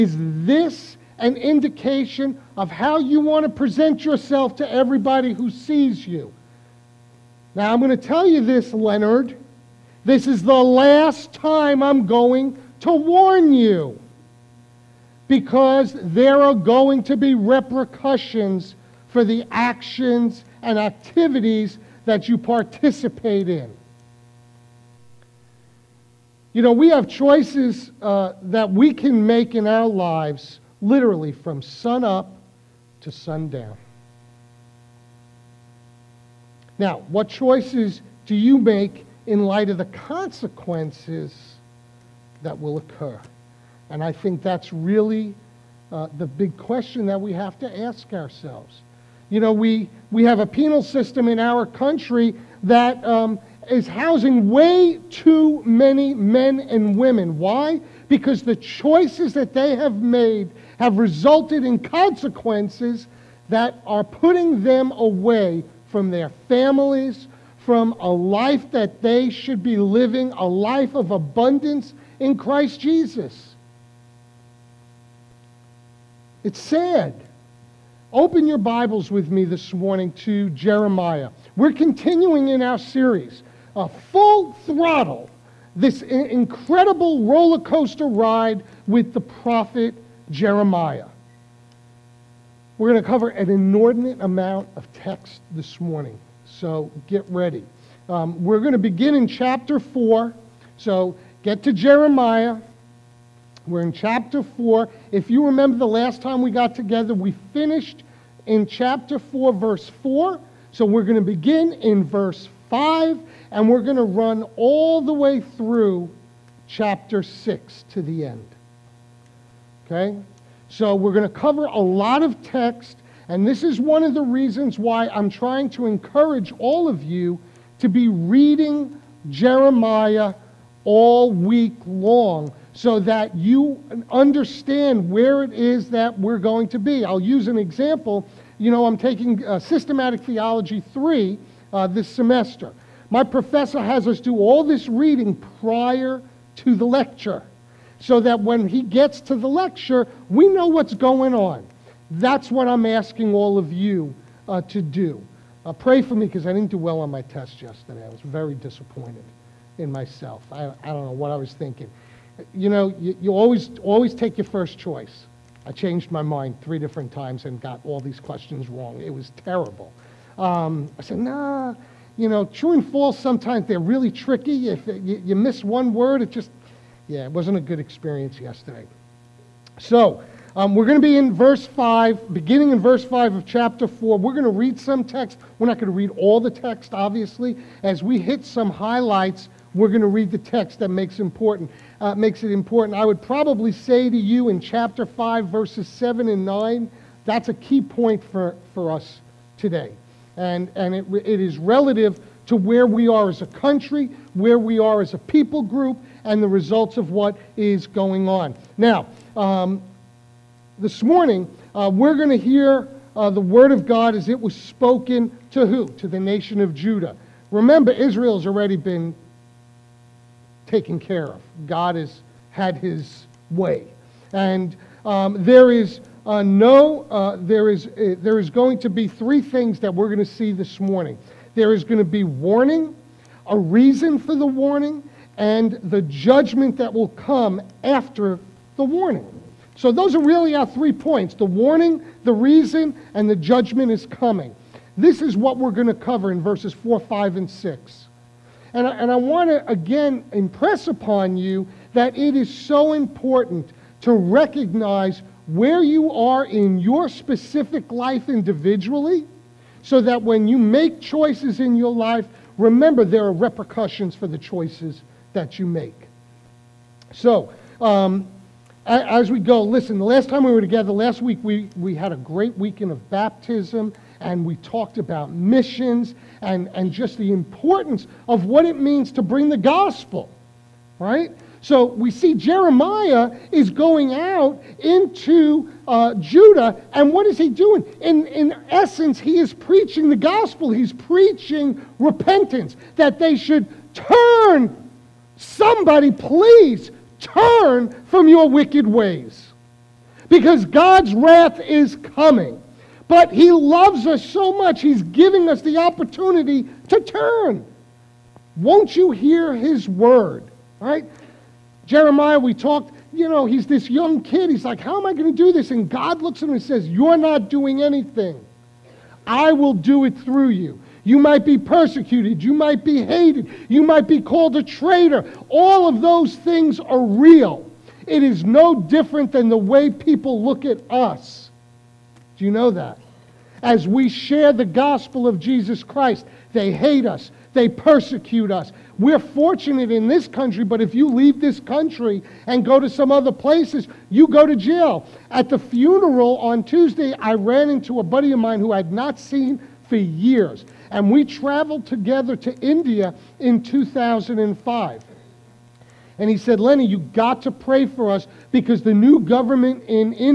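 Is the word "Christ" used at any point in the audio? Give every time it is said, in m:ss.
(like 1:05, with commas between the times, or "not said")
1:12, 5:35.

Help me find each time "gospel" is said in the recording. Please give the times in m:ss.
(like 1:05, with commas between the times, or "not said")
4:39, 4:50, 5:34.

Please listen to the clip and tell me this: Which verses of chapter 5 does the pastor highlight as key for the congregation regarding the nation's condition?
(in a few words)
verses 7 and 9.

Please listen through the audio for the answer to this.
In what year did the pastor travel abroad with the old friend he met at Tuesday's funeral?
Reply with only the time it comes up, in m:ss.
5:53.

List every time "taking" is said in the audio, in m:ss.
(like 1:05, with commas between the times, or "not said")
2:18.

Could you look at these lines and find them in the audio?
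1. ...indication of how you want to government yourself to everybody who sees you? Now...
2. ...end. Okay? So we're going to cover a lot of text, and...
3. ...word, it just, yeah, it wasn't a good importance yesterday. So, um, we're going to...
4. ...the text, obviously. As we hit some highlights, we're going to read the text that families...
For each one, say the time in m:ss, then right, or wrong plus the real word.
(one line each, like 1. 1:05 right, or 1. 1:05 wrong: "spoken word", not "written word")
1. 0:01 wrong: "present", not "government"
2. 1:58 right
3. 2:55 wrong: "experience", not "importance"
4. 3:06 wrong: "makes", not "families".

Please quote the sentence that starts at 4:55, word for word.
Somebody, please turn from your wicked ways, because God's wrath is coming.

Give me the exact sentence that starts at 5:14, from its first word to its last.
He's like, how am I going to do this?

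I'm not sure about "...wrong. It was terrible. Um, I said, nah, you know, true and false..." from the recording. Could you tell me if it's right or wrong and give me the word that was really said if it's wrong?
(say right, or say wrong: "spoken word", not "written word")
right.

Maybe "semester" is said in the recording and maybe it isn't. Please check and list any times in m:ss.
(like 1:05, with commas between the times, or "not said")
2:22.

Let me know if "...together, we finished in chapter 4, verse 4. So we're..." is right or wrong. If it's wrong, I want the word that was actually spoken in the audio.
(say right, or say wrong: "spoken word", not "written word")
right.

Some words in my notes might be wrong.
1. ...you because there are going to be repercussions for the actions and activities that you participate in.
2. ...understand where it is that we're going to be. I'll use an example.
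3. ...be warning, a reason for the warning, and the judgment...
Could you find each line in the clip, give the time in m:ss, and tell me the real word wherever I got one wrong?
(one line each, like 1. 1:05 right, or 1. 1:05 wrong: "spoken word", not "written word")
1. 0:13 right
2. 2:14 right
3. 3:52 right.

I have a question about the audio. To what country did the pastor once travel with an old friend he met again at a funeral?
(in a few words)
India.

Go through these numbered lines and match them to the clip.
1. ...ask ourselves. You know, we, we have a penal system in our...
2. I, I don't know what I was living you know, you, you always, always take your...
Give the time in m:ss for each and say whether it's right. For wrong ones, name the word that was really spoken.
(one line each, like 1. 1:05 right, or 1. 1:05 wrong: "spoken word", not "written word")
1. 0:47 right
2. 2:40 wrong: "thinking", not "living".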